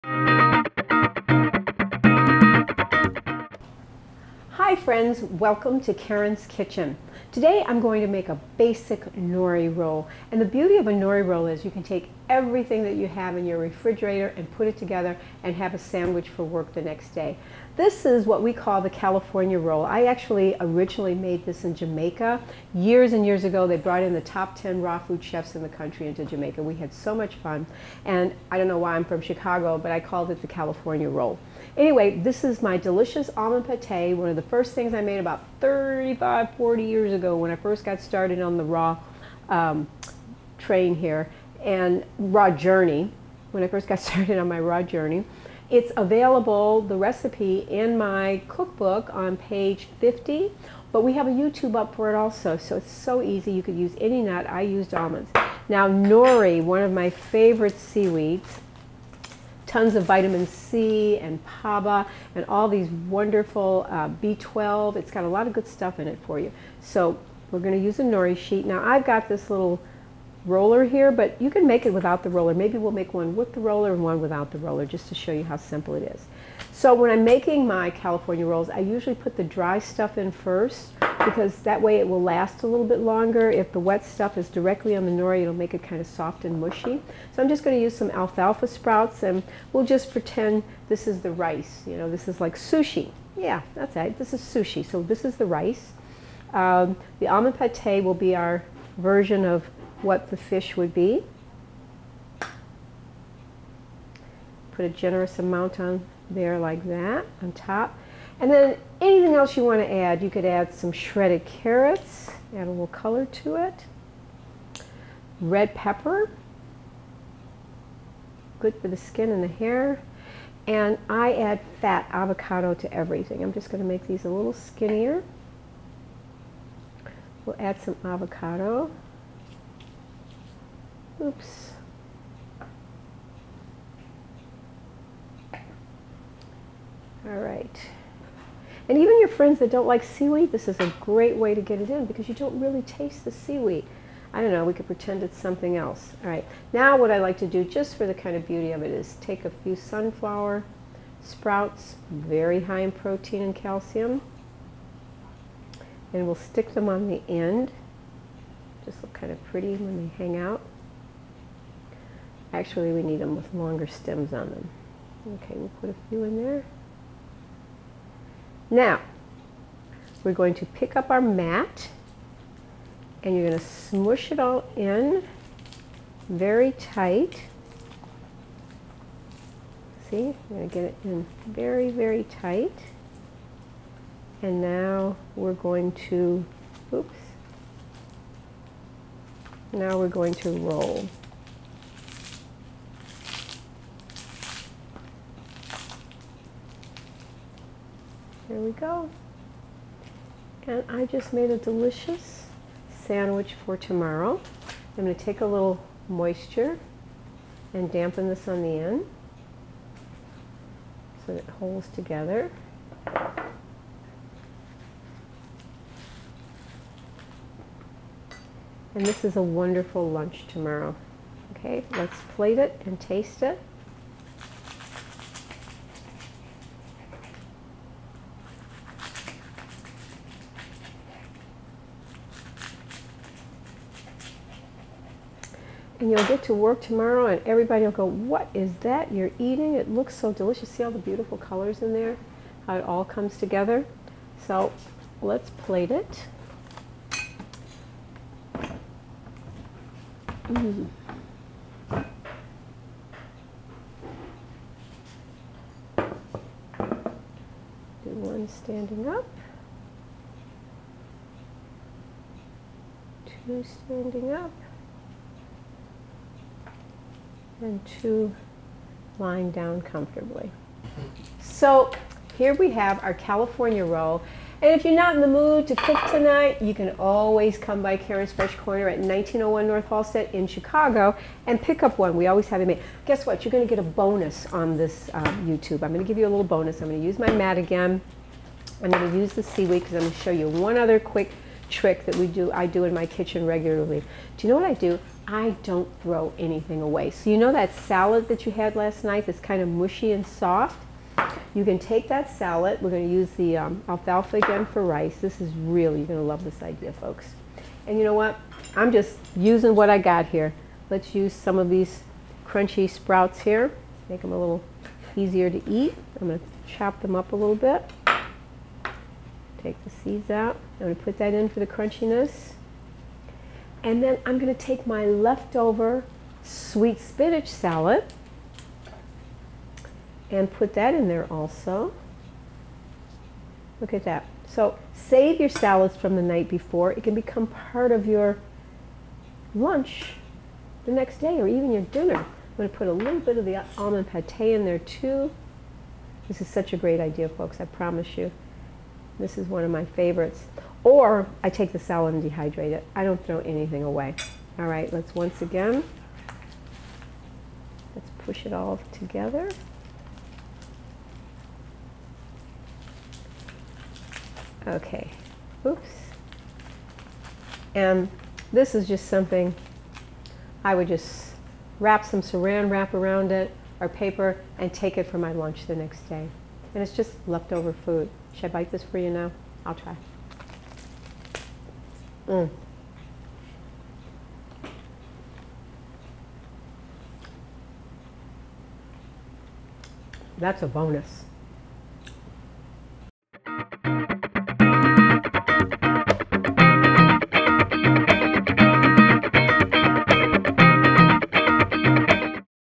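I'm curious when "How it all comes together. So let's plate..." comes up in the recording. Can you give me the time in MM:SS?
04:02.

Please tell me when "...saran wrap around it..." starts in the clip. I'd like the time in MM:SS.
06:12.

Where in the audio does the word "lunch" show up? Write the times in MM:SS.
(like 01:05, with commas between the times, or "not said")
03:40, 05:39, 06:15.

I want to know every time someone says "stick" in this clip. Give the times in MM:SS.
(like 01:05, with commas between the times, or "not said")
02:36.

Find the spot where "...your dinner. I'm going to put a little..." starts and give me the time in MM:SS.
05:41.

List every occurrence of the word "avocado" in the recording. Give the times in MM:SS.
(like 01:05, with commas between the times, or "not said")
02:02, 02:08.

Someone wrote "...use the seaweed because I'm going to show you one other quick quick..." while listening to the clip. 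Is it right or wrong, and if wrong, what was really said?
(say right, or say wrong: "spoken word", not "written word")
wrong: "trick", not "quick".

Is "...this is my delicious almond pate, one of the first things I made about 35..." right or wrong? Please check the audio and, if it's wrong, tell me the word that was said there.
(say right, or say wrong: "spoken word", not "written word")
right.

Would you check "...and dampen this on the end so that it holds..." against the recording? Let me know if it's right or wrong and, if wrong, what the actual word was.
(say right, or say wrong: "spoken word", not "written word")
right.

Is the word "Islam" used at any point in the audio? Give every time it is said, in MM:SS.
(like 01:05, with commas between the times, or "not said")
not said.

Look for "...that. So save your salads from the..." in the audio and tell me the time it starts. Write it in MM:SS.
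05:34.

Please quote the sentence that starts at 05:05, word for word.
This is really, you're going to love this idea, folks.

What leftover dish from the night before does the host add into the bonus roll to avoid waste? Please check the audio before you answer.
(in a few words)
sweet spinach salad.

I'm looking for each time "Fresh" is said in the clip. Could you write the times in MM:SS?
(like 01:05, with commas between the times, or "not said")
04:38.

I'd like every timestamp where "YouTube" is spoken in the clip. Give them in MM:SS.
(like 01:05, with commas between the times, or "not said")
00:51, 04:45.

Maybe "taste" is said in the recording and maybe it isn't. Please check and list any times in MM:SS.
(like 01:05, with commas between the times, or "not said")
02:22, 03:42.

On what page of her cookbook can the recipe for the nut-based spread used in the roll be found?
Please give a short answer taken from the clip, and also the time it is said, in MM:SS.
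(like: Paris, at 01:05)
50, at 00:49.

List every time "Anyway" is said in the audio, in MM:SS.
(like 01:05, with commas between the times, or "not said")
00:31.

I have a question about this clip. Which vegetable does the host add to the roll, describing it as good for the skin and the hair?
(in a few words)
Red pepper.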